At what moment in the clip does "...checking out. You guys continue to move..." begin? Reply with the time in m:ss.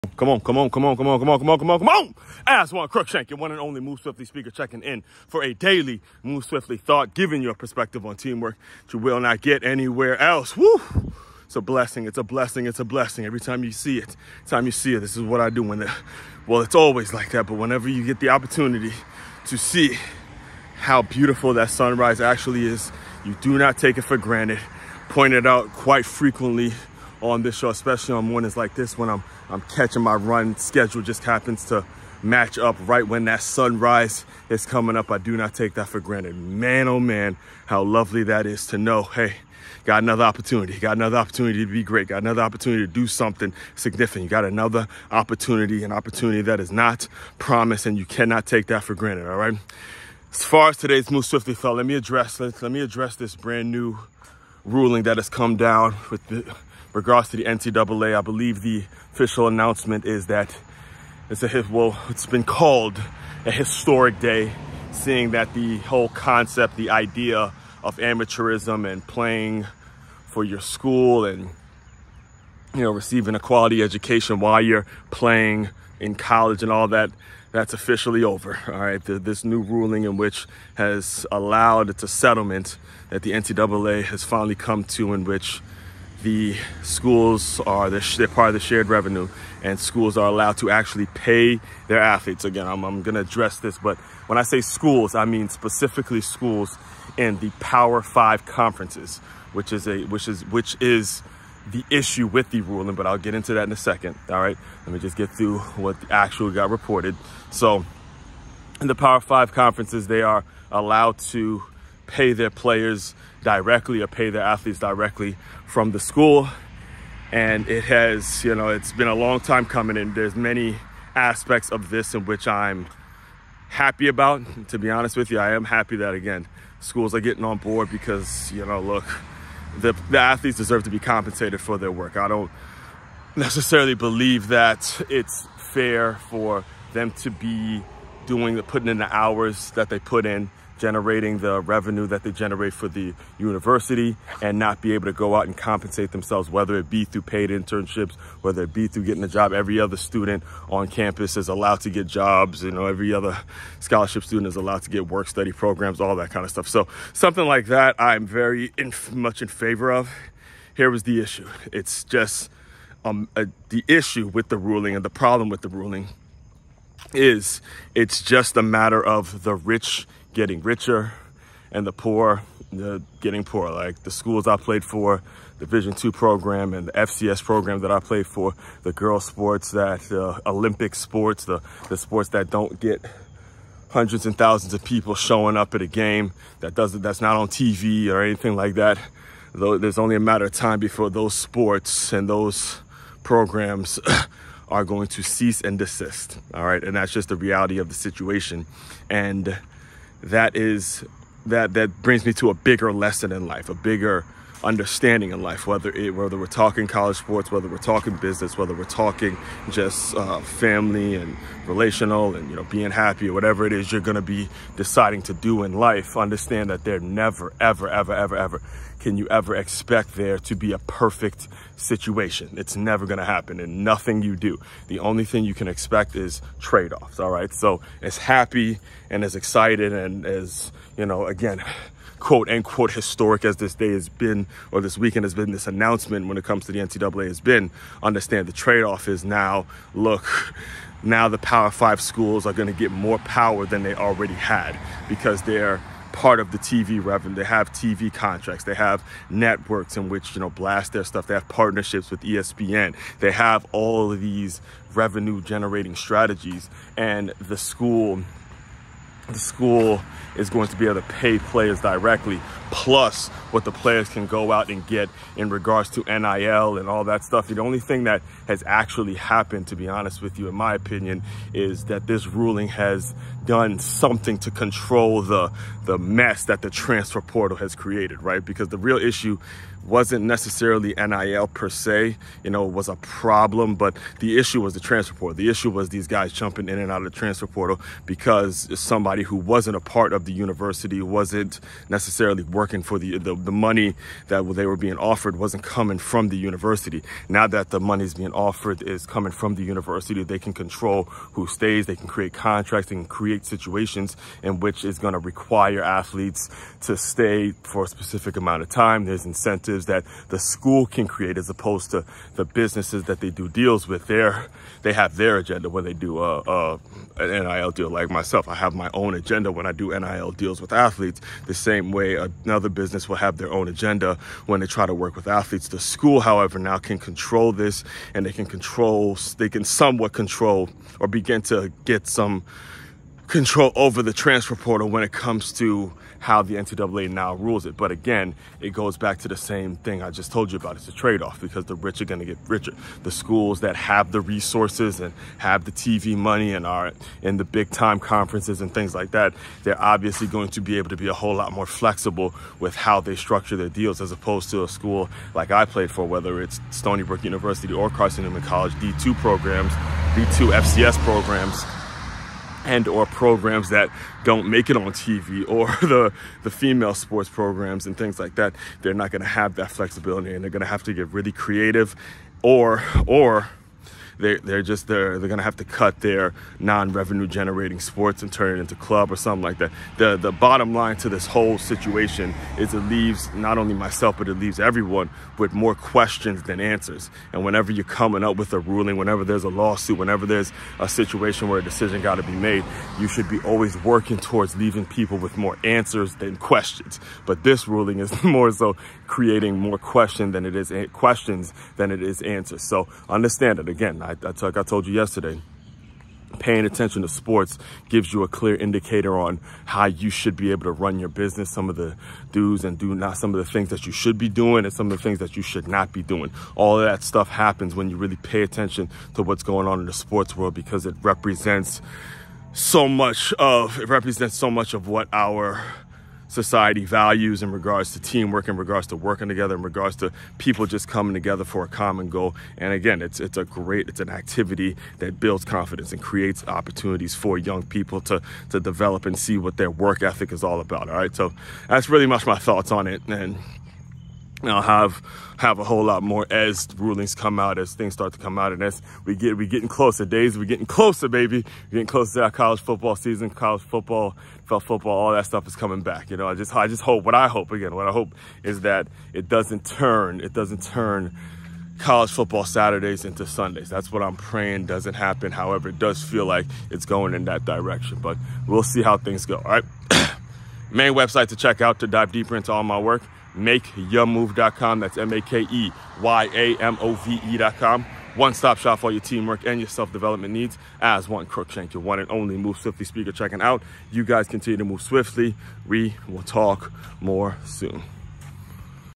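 8:03.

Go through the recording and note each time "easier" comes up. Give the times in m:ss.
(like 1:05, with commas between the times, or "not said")
not said.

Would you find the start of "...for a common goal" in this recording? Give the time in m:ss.
7:11.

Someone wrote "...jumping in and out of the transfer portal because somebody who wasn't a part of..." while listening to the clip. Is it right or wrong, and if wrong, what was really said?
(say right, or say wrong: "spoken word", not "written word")
right.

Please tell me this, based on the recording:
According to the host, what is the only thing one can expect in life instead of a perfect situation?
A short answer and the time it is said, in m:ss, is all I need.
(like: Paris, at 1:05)
trade-offs, at 3:46.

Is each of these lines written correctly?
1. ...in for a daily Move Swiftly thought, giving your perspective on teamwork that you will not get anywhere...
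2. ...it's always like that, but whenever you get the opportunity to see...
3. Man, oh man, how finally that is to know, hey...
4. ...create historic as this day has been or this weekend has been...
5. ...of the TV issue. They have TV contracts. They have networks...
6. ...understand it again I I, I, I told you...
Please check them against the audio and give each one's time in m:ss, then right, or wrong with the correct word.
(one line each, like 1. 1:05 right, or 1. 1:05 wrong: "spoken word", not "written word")
1. 0:04 right
2. 0:16 right
3. 0:36 wrong: "lovely", not "finally"
4. 3:52 wrong: "unquote", not "create"
5. 4:06 wrong: "revenue", not "issue"
6. 6:43 right.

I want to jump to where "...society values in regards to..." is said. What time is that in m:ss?
7:06.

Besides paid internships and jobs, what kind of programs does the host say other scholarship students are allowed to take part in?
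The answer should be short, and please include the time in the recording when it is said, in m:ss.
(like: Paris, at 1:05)
work study, at 2:35.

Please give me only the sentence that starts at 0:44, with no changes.
You got another opportunity, an opportunity that is not promised and you cannot take that for granted, all right?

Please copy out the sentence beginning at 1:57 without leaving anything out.
And it has, you know, it's been a long time coming and there's many aspects of this in which I'm happy about.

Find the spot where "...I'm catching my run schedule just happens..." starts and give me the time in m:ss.
0:29.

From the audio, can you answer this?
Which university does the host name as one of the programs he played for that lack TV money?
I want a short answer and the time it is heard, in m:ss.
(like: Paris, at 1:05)
Stony Brook University, at 5:56.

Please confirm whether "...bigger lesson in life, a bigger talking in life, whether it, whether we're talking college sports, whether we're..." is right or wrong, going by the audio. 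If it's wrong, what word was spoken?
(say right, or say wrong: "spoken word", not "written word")
wrong: "understanding", not "talking".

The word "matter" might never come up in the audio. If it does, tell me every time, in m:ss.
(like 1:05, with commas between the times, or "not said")
2:48, 3:10.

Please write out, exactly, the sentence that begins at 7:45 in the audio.
However, it does feel like it's going in that direction.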